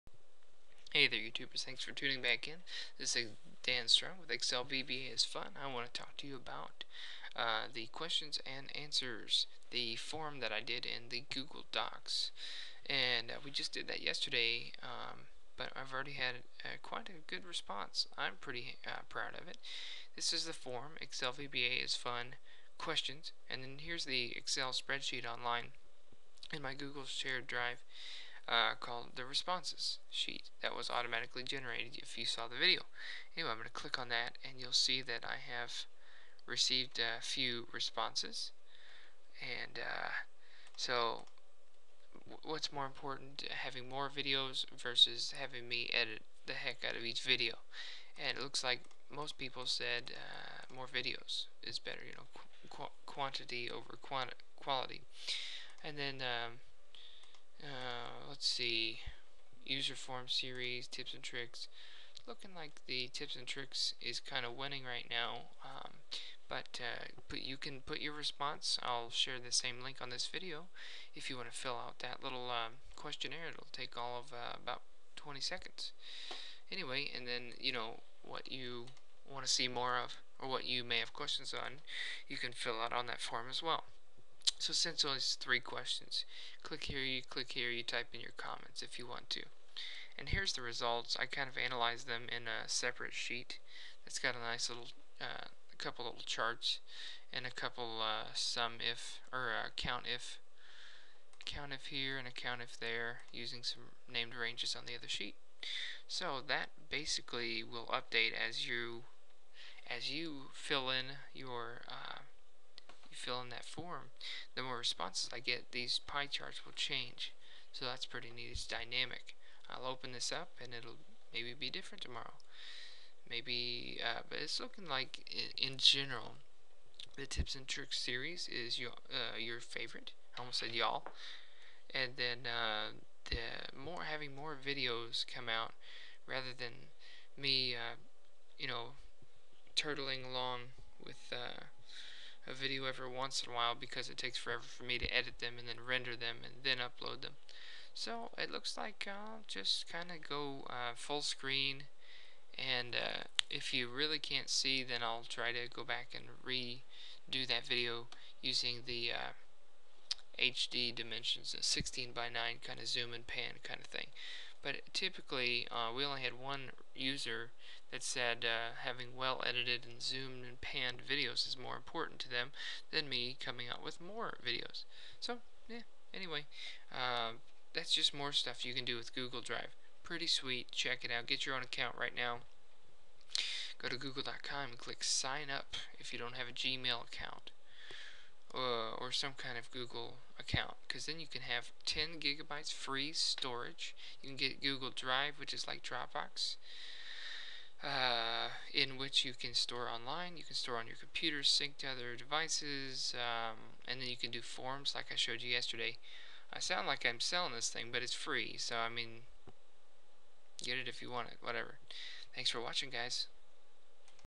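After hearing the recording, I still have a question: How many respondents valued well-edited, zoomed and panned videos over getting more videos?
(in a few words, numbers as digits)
1.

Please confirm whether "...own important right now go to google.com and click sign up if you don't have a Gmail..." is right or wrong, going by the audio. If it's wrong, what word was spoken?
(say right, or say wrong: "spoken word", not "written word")
wrong: "account", not "important".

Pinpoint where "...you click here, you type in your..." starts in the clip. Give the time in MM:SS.
01:27.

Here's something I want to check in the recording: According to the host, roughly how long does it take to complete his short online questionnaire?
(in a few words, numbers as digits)
20 seconds.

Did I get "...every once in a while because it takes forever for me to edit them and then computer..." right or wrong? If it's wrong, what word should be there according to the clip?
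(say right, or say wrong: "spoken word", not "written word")
wrong: "render", not "computer".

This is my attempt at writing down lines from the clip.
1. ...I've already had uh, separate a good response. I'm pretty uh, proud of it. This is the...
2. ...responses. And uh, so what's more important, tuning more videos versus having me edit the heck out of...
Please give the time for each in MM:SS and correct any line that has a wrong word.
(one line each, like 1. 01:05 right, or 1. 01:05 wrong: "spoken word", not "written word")
1. 00:15 wrong: "quite", not "separate"
2. 00:37 wrong: "having", not "tuning".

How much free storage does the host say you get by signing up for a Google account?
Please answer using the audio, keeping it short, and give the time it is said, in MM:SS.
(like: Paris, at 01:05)
10 gigabytes, at 03:11.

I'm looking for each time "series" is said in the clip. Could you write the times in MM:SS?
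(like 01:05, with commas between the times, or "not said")
01:00, 02:07.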